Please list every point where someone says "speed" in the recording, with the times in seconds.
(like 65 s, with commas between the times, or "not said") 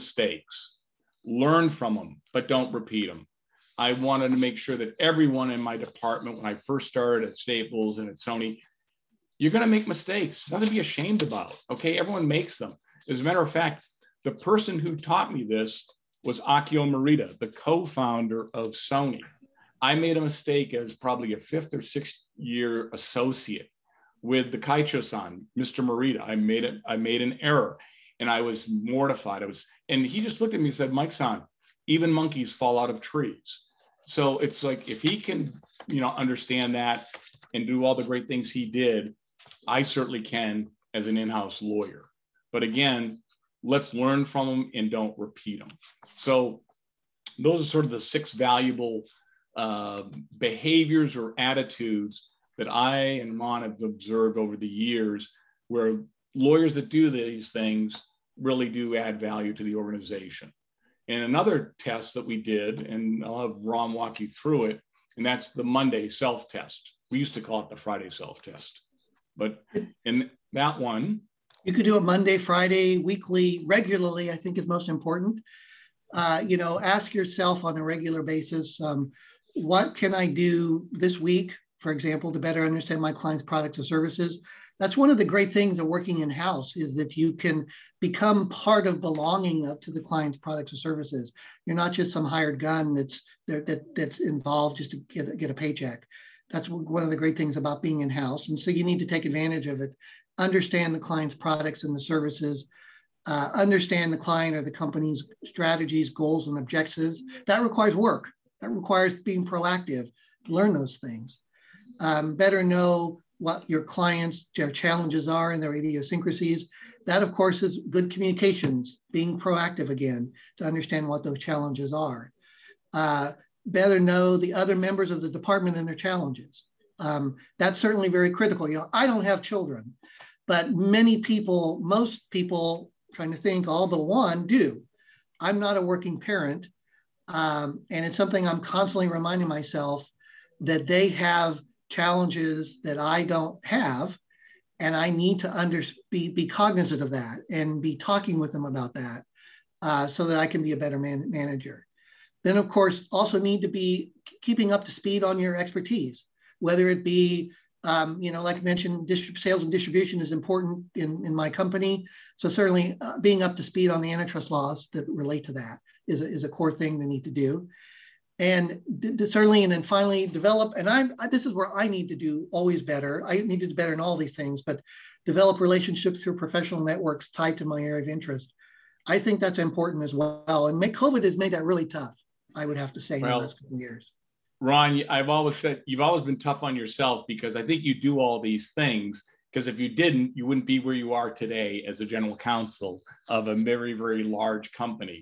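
154 s, 163 s.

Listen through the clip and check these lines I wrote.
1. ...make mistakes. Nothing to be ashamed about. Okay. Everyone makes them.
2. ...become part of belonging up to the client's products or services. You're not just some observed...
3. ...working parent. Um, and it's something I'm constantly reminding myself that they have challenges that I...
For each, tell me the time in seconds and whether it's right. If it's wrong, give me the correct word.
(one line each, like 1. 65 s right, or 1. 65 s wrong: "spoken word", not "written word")
1. 9 s right
2. 87 s wrong: "hired", not "observed"
3. 135 s right.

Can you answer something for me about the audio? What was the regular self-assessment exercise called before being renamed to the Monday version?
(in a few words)
Friday self test.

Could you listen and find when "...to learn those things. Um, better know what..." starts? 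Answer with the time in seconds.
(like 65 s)
110 s.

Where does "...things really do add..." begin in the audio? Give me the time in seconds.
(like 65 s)
57 s.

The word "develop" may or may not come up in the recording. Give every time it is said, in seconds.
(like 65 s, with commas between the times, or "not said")
170 s, 175 s.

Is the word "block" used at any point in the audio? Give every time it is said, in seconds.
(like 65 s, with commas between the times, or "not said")
not said.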